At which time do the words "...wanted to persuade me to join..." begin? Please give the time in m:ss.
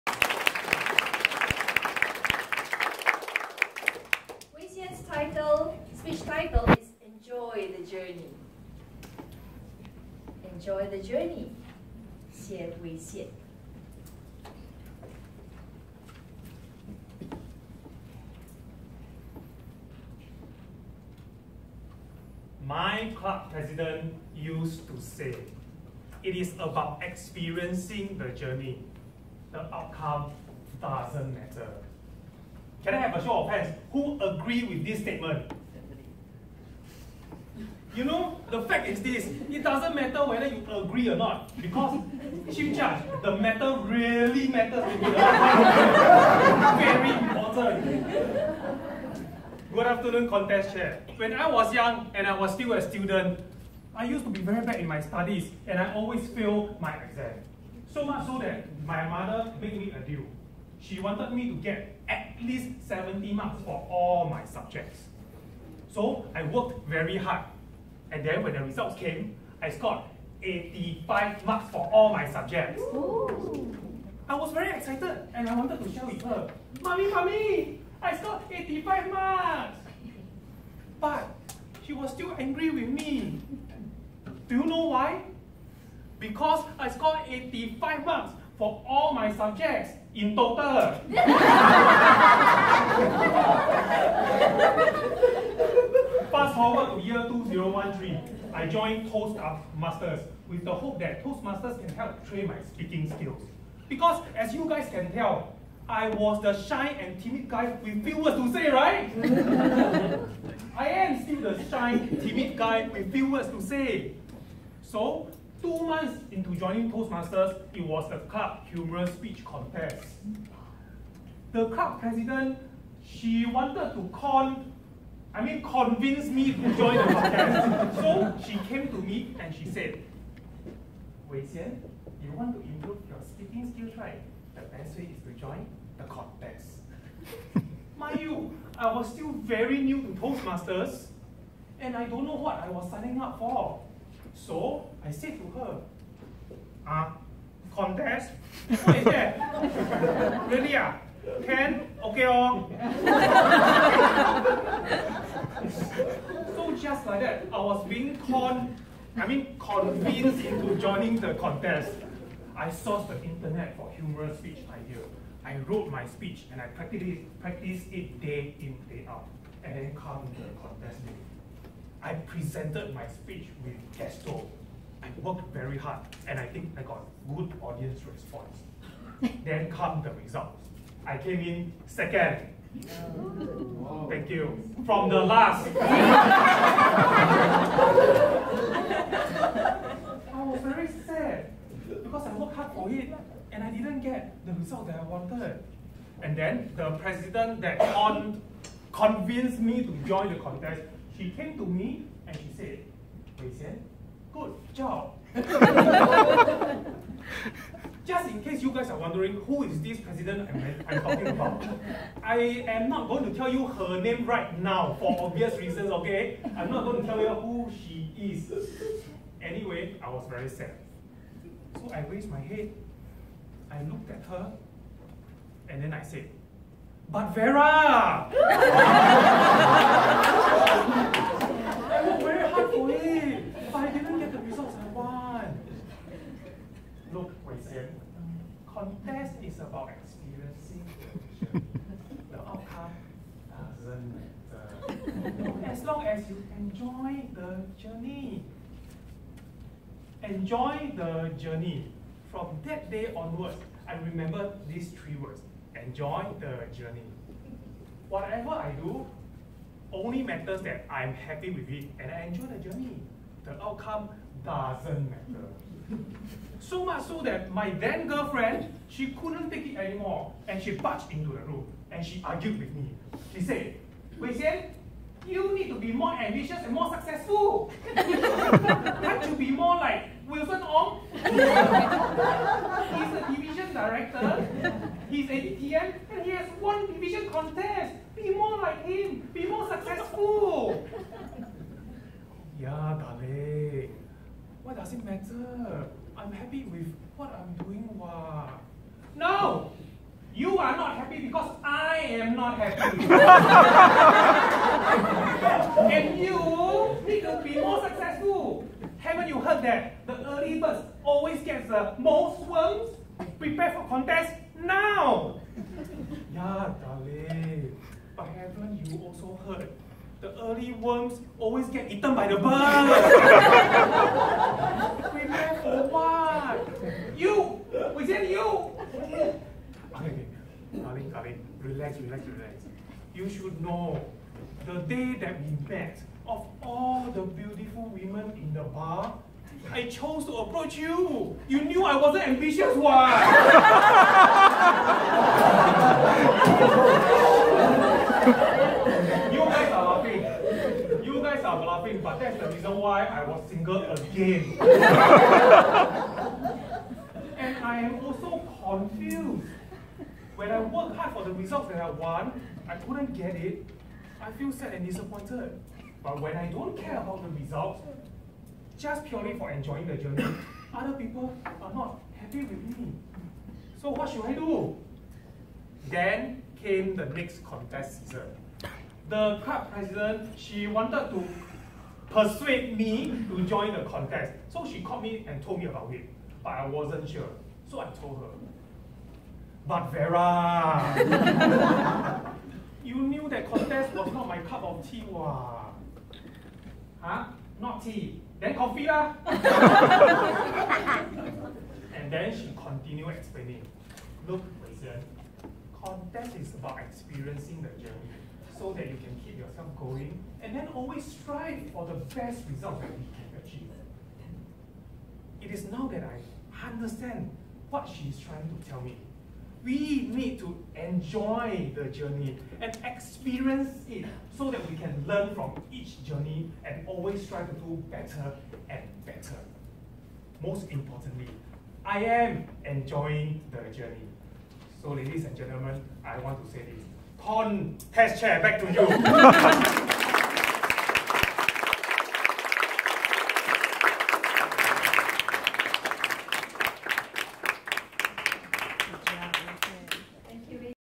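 6:20.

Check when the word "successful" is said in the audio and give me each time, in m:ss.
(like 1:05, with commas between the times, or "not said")
4:36, 4:49, 5:07.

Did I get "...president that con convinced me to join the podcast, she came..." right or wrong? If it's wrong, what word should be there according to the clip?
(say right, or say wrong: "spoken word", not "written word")
wrong: "contest", not "podcast".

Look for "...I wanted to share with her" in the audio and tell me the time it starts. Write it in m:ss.
1:15.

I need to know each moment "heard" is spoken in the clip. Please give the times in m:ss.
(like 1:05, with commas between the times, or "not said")
5:09, 5:19.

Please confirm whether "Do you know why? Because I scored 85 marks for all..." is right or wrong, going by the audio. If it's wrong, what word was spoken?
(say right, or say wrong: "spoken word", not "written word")
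right.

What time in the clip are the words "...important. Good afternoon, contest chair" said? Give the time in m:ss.
0:47.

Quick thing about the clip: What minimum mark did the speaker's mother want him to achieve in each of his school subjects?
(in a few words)
70.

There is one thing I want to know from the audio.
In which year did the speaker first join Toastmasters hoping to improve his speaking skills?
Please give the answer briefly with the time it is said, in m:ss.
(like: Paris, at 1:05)
2013, at 1:37.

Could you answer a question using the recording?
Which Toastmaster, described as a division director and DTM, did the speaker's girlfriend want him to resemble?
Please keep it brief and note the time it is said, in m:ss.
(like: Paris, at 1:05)
Wilson Ong, at 4:40.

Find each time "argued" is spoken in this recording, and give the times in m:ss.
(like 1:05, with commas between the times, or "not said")
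4:32.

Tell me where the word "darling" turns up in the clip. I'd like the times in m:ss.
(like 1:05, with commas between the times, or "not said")
4:53, 5:16.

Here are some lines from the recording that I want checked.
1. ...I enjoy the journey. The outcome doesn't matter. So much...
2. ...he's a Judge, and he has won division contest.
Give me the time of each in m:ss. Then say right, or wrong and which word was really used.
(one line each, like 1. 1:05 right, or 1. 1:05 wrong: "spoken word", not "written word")
1. 4:22 right
2. 4:45 wrong: "DTM", not "Judge".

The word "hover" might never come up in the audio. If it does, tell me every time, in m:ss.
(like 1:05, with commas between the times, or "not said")
not said.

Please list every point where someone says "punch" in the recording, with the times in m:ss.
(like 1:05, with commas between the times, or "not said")
not said.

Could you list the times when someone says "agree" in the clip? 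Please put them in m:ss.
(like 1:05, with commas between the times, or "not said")
0:34, 0:40.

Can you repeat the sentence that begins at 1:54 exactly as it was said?
So, two months into joining Toastmasters, it was the club humorous speech contest.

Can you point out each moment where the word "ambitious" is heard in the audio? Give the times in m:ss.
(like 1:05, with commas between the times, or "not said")
4:36, 5:42.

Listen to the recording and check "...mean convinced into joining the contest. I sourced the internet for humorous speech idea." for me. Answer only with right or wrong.
right.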